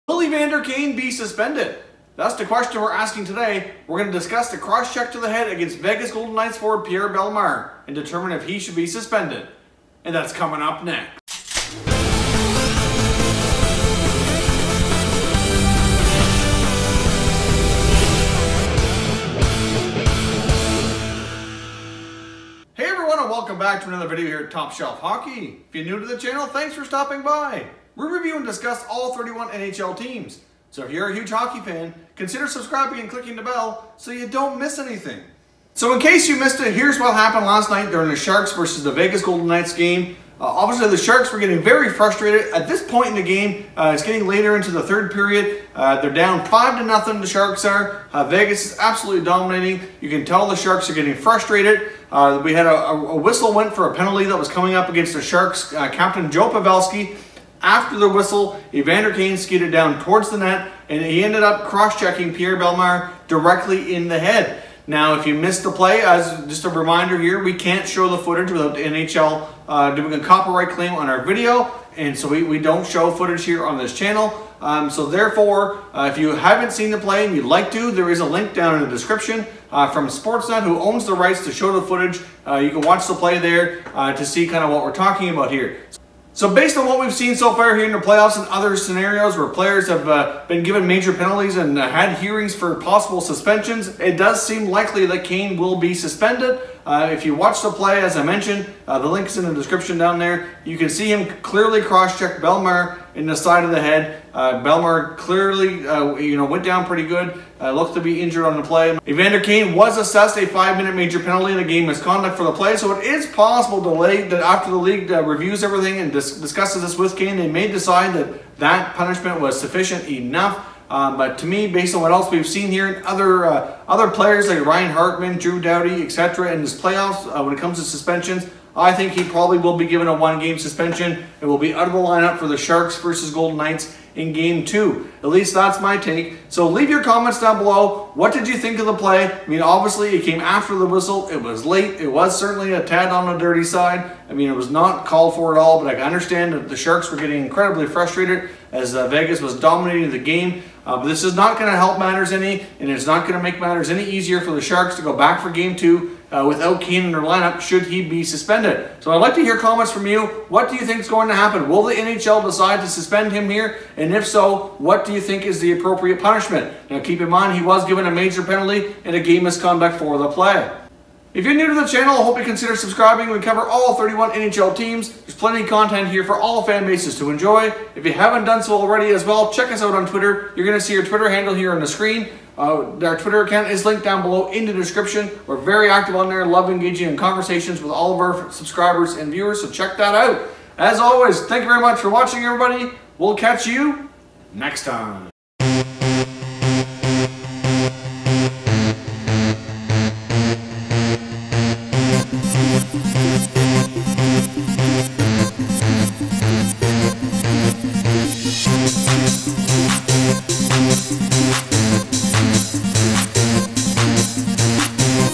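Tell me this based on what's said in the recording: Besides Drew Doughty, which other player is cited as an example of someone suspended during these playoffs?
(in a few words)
Ryan Hartman.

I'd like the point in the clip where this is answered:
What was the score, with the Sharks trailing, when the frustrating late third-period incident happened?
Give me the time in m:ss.
0:46.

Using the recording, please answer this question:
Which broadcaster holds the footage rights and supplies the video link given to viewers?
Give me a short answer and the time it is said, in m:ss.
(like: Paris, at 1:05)
Sportsnet, at 1:20.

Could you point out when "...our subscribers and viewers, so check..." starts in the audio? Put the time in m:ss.
3:08.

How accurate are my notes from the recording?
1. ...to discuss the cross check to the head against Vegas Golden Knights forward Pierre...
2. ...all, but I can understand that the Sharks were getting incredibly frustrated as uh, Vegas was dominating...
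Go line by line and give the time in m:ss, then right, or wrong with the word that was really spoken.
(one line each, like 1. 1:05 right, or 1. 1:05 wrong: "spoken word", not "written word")
1. 0:04 right
2. 2:25 right.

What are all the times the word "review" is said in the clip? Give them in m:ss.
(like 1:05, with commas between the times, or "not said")
0:28, 1:55.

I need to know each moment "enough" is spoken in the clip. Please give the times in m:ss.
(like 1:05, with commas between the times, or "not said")
2:00.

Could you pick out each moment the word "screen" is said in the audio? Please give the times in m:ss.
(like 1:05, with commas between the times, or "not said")
3:01.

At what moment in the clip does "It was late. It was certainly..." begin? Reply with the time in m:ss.
2:21.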